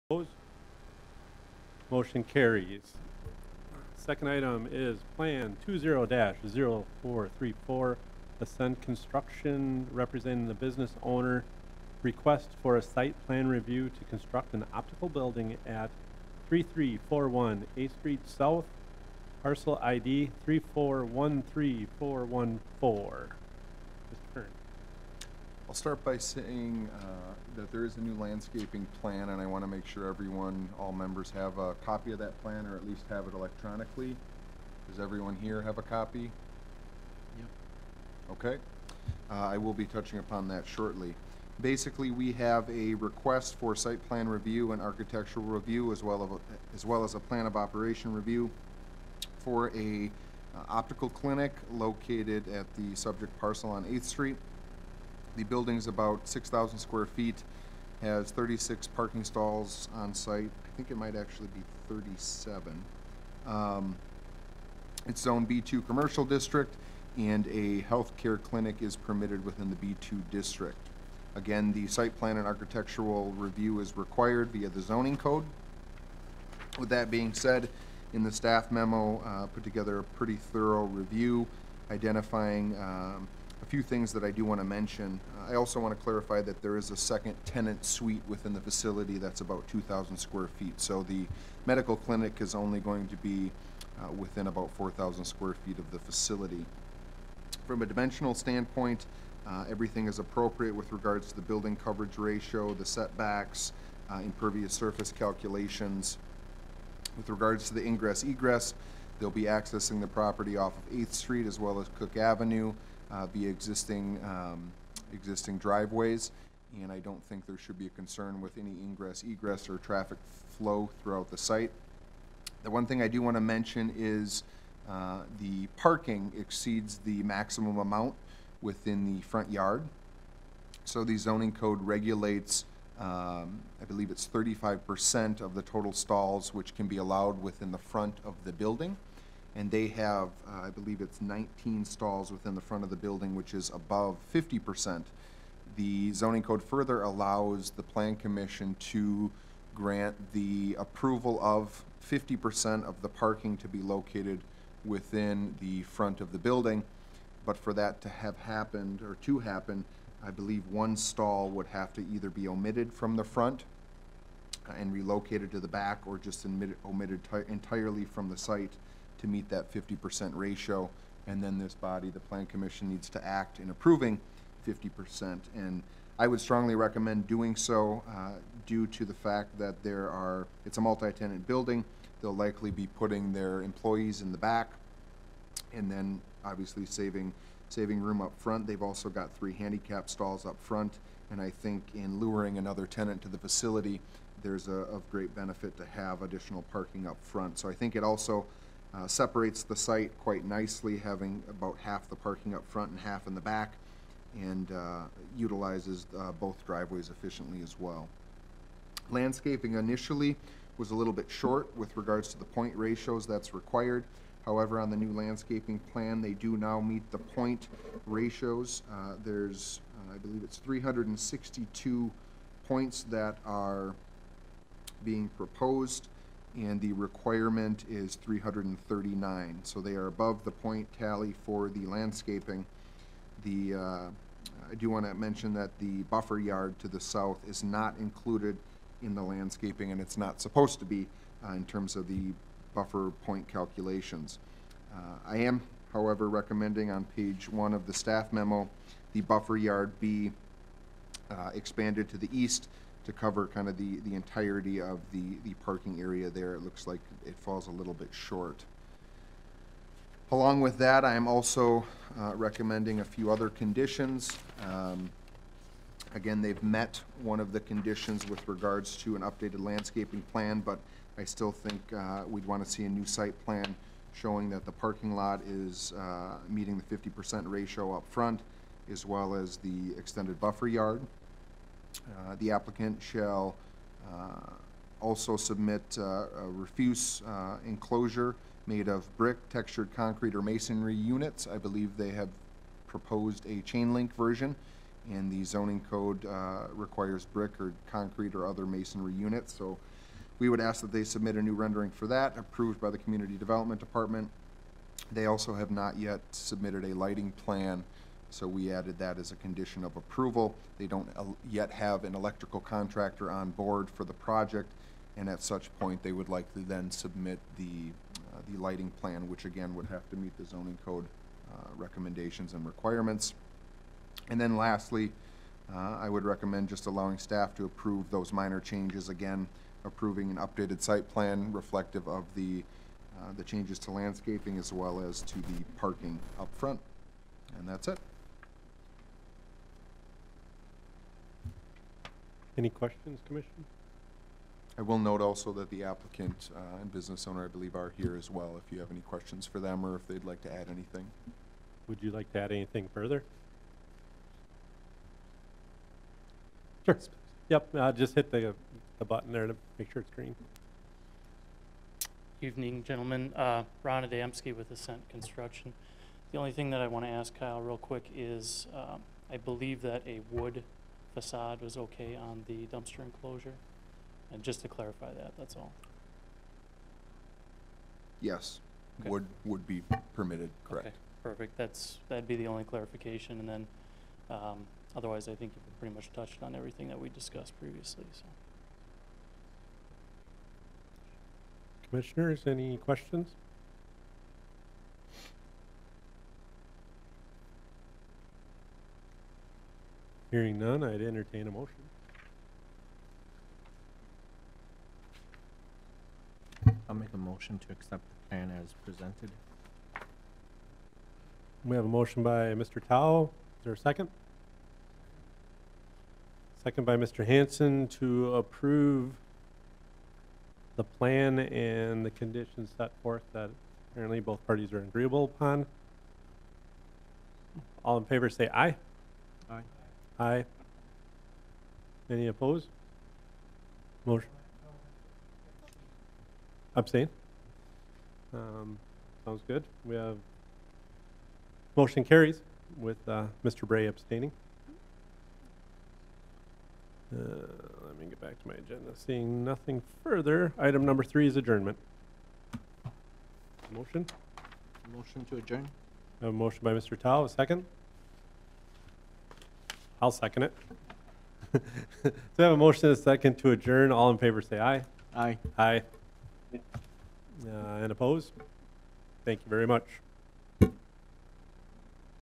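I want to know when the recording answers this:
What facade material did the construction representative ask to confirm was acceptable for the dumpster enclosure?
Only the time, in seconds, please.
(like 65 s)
370 s.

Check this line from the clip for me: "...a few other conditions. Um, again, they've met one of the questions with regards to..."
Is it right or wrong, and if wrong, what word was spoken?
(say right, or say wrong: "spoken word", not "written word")
wrong: "conditions", not "questions".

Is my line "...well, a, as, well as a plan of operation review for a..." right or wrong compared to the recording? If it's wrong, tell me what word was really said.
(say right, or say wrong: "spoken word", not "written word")
right.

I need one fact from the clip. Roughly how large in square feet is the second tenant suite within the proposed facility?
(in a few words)
2,000.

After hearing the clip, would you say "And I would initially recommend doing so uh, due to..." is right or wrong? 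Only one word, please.
wrong.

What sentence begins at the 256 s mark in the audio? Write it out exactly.
It looks like it falls a little bit short.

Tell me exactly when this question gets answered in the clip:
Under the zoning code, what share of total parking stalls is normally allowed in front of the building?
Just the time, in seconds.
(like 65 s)
134 s.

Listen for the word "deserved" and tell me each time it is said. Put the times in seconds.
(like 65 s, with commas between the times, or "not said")
not said.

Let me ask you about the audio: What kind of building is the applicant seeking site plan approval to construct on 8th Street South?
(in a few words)
Optical building.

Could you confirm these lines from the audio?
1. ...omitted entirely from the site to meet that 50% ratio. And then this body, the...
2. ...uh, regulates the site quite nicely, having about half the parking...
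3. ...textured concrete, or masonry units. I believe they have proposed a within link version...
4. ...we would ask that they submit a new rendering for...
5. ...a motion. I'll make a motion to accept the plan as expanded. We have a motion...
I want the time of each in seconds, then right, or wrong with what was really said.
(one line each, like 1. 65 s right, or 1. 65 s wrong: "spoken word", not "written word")
1. 166 s right
2. 198 s wrong: "separates", not "regulates"
3. 289 s wrong: "chain", not "within"
4. 300 s right
5. 401 s wrong: "presented", not "expanded".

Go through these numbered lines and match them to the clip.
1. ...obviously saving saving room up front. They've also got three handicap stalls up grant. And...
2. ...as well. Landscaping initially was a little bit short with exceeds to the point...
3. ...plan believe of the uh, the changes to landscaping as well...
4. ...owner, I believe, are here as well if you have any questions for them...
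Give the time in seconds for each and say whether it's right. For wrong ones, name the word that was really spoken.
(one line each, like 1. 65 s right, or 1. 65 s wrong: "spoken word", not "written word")
1. 186 s wrong: "front", not "grant"
2. 207 s wrong: "regards", not "exceeds"
3. 331 s wrong: "reflective", not "believe"
4. 347 s right.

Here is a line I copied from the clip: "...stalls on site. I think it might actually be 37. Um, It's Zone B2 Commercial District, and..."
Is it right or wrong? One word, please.
right.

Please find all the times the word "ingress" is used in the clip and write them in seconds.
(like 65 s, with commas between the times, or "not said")
107 s, 118 s.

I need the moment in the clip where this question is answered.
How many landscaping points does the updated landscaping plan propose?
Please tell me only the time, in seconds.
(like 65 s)
220 s.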